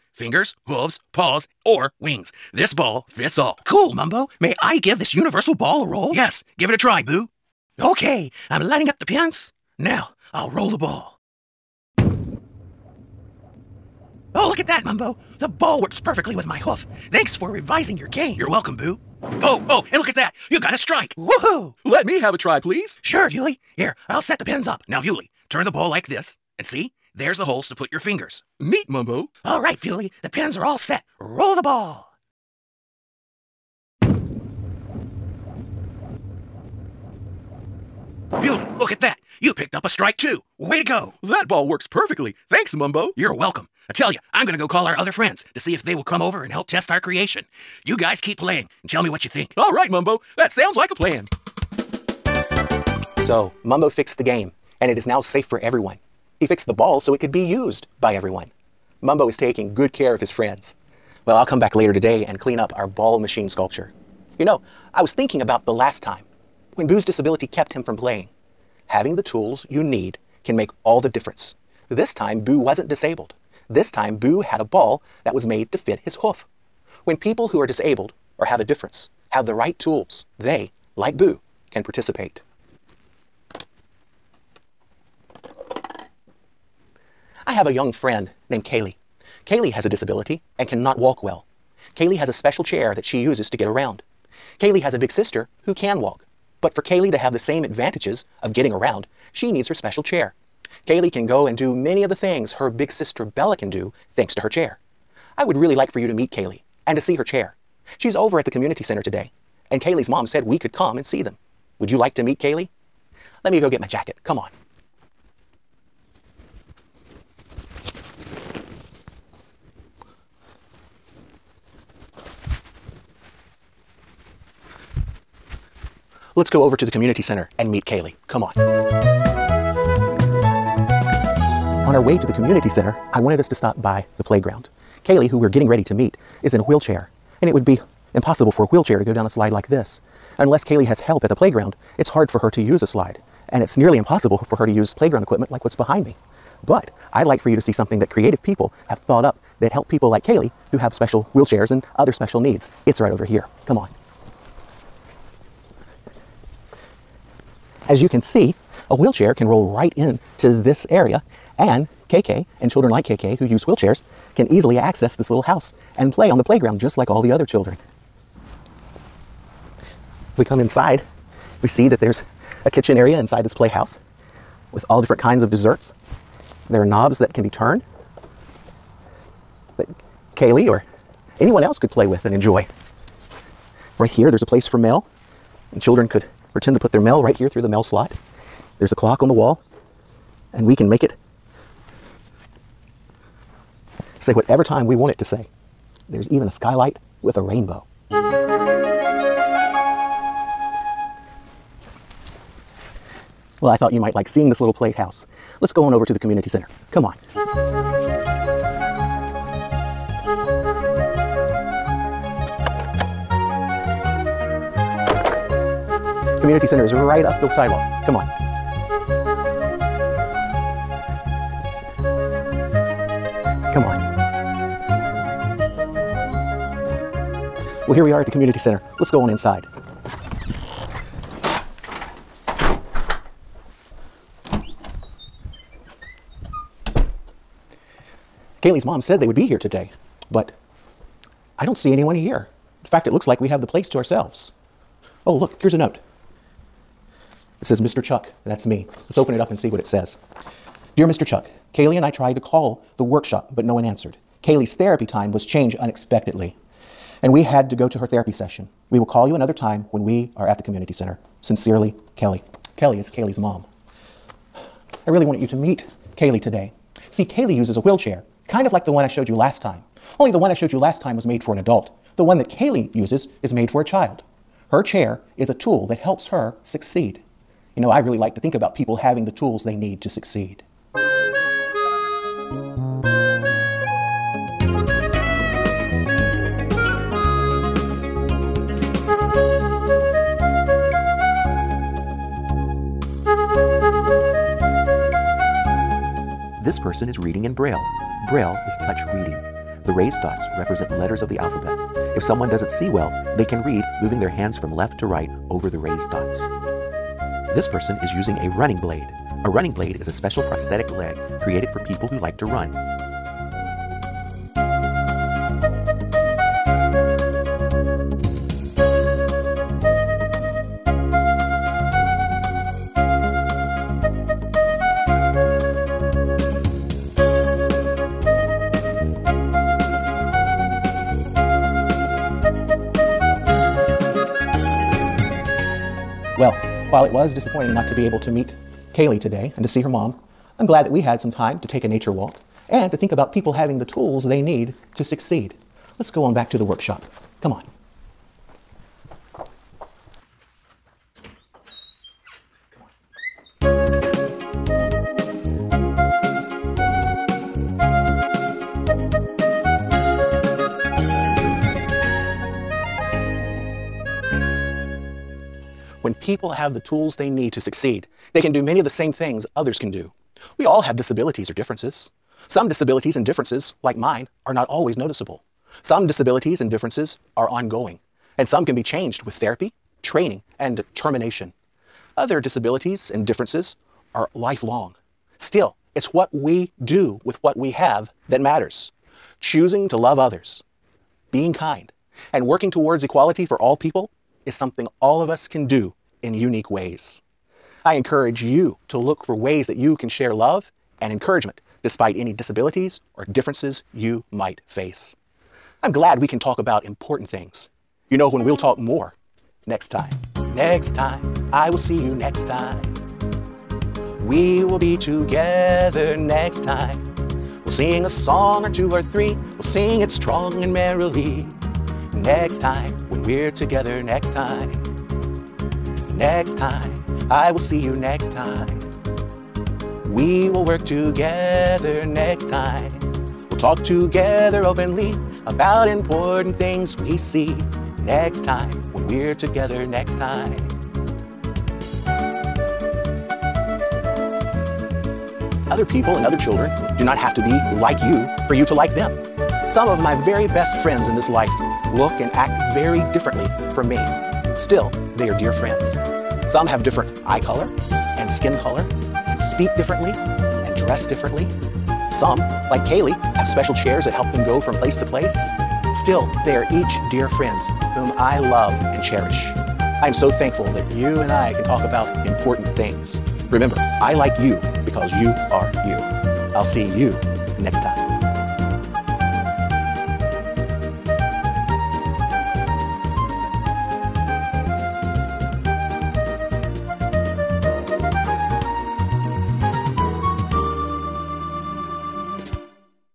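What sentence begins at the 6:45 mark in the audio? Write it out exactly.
I'm glad we can talk about important things.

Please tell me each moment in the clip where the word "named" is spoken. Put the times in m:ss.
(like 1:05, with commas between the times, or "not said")
1:28.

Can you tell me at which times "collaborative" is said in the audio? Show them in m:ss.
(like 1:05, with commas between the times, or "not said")
not said.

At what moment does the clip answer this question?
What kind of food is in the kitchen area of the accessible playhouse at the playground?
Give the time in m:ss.
2:55.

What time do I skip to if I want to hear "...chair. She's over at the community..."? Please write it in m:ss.
1:47.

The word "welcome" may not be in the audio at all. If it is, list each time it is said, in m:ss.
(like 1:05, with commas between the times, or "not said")
0:18, 0:43.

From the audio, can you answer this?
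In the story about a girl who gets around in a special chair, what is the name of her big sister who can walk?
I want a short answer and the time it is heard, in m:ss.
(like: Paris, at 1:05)
Bella, at 1:43.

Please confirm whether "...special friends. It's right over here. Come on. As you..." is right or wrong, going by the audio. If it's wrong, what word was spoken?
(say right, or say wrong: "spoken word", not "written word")
wrong: "needs", not "friends".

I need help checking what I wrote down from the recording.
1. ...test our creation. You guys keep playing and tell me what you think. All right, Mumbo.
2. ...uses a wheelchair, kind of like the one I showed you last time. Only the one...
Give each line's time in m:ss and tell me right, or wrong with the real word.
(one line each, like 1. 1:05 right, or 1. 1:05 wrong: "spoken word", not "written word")
1. 0:46 right
2. 4:27 right.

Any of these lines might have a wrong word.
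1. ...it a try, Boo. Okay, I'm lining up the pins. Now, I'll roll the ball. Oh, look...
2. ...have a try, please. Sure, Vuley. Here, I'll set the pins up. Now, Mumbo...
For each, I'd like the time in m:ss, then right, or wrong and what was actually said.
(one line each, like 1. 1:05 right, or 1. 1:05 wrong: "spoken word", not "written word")
1. 0:06 right
2. 0:22 wrong: "Vuley", not "Mumbo".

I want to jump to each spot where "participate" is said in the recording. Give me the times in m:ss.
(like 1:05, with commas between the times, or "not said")
1:21.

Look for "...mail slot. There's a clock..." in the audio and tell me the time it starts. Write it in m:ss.
3:07.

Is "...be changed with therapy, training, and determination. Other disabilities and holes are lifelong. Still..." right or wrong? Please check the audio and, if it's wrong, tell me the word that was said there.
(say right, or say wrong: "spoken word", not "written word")
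wrong: "differences", not "holes".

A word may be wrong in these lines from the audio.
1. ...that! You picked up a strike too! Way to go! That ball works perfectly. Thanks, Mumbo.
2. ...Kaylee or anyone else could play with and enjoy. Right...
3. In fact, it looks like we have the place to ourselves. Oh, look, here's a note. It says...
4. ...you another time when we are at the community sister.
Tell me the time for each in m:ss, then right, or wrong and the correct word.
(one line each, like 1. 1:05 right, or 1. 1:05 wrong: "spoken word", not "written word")
1. 0:39 right
2. 3:00 right
3. 4:02 right
4. 4:19 wrong: "center", not "sister".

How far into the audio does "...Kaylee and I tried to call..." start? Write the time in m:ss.
4:11.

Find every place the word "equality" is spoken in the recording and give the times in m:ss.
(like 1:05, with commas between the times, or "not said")
6:33.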